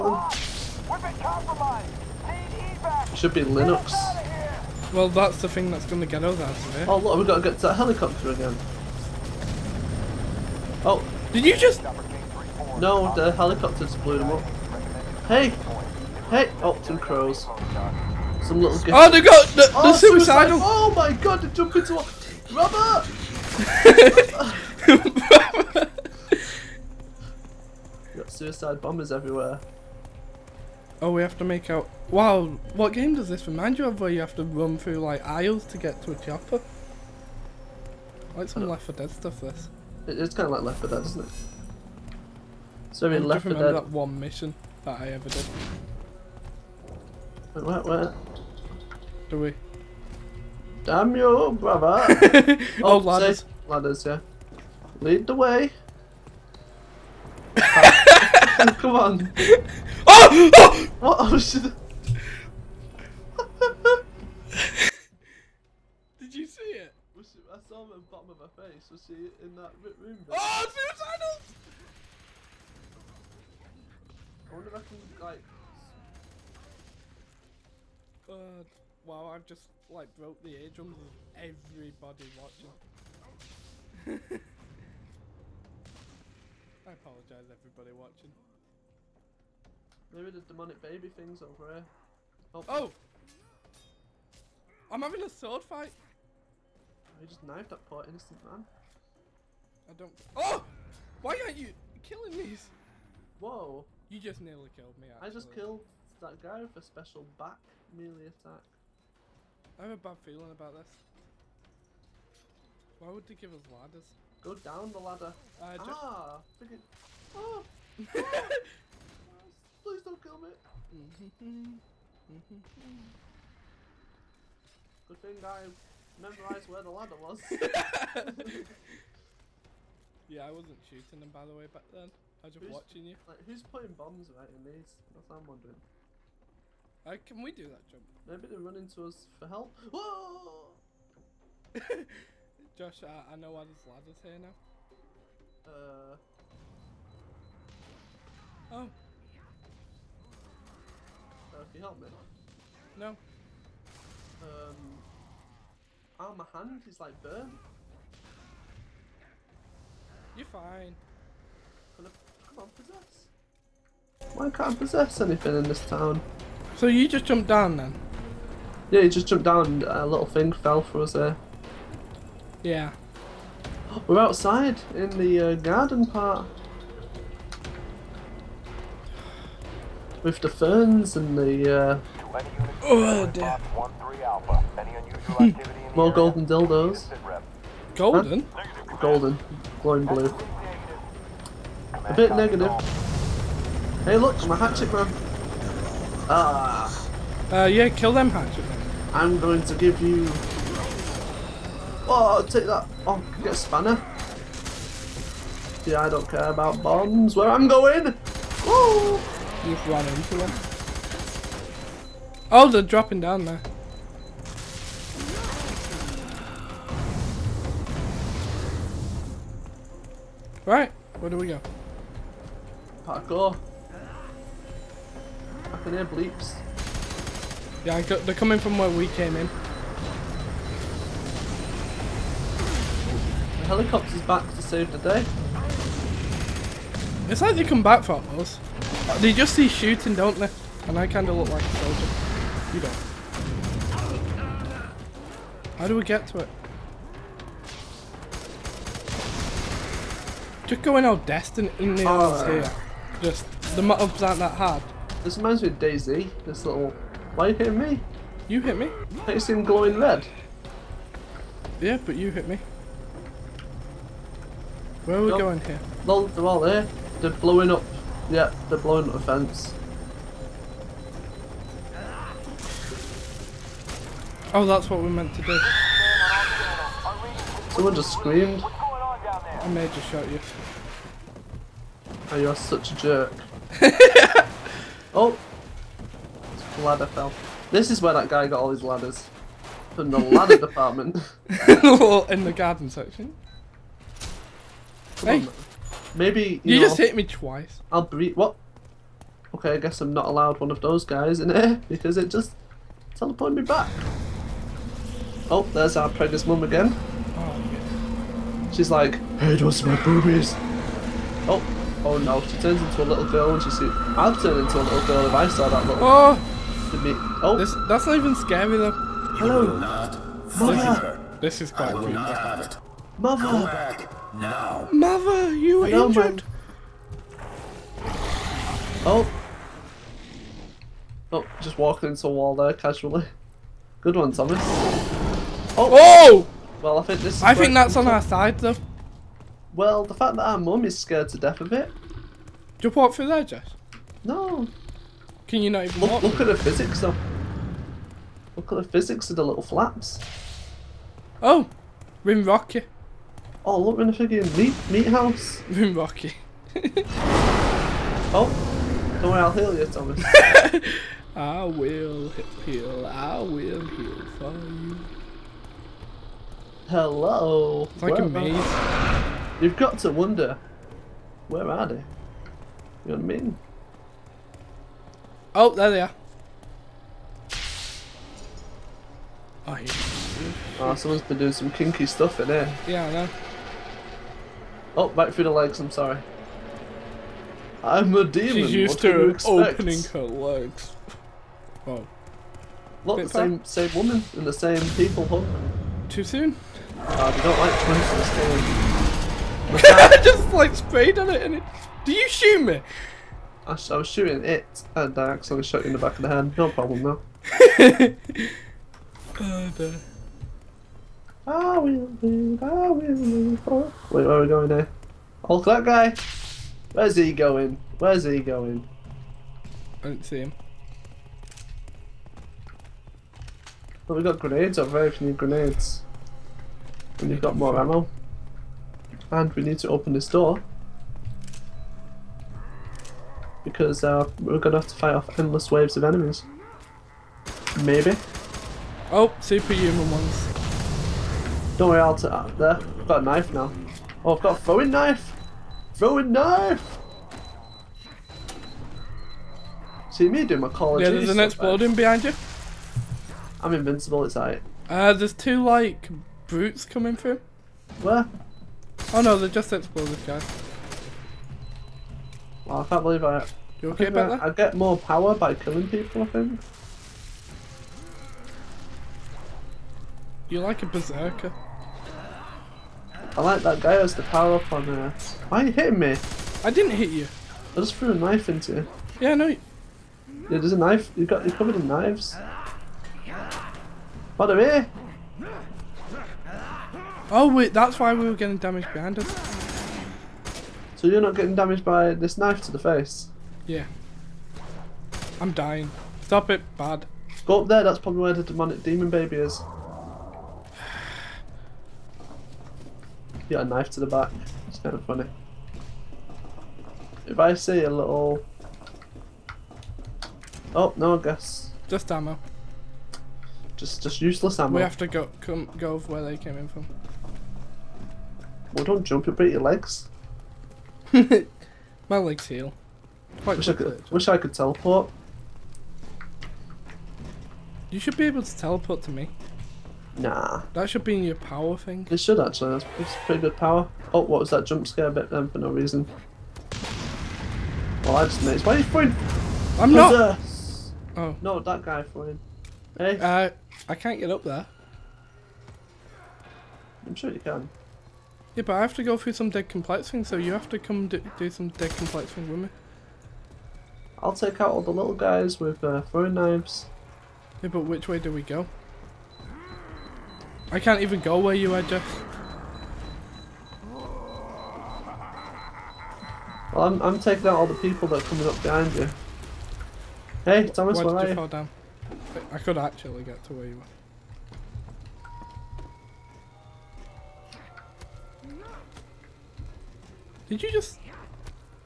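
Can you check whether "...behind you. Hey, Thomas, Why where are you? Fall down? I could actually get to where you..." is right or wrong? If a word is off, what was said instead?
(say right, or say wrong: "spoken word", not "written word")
right.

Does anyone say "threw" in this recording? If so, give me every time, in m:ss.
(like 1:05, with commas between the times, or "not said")
7:57.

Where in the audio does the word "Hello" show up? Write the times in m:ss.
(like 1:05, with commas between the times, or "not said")
5:19, 5:25, 6:06.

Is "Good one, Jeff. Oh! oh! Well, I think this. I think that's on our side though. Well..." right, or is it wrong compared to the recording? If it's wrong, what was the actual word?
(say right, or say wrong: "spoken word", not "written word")
wrong: "Thomas", not "Jeff".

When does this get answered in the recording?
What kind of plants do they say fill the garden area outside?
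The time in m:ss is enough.
3:00.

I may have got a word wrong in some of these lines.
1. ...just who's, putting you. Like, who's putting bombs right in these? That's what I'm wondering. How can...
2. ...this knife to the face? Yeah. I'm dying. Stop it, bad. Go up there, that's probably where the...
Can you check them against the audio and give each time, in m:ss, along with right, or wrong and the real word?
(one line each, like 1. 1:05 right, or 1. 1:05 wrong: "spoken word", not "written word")
1. 2:12 wrong: "watching", not "putting"
2. 8:12 right.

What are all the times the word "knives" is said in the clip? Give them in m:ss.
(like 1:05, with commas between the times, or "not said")
8:01, 9:16.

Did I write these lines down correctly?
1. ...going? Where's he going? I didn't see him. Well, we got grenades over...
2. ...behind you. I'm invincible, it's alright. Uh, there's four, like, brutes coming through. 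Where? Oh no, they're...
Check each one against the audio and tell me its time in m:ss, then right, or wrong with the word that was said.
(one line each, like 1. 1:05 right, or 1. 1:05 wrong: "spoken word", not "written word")
1. 6:57 right
2. 7:31 wrong: "two", not "four".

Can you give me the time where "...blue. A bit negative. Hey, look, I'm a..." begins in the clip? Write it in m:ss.
3:10.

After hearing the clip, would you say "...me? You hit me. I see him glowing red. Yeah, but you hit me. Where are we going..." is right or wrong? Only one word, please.
right.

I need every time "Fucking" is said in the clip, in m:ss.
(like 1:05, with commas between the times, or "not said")
3:45.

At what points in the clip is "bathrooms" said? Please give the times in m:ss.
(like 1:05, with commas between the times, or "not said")
not said.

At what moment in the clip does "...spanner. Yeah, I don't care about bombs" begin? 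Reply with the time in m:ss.
3:23.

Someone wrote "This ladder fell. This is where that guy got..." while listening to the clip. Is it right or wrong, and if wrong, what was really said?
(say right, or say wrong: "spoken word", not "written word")
right.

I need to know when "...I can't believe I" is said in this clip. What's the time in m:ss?
7:42.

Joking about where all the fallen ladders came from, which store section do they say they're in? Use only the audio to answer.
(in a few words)
The garden section.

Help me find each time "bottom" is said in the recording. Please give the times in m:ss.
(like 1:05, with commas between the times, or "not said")
1:08.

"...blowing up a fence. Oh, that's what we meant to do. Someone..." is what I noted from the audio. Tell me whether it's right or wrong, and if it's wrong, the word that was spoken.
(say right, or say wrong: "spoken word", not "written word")
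right.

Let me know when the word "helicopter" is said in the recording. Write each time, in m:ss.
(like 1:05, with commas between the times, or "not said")
0:07, 0:13, 3:53.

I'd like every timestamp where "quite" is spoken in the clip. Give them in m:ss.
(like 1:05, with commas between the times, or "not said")
5:21, 8:43.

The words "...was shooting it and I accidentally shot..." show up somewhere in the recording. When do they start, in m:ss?
6:43.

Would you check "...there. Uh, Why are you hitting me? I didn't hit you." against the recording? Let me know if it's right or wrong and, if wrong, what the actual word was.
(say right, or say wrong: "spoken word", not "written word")
right.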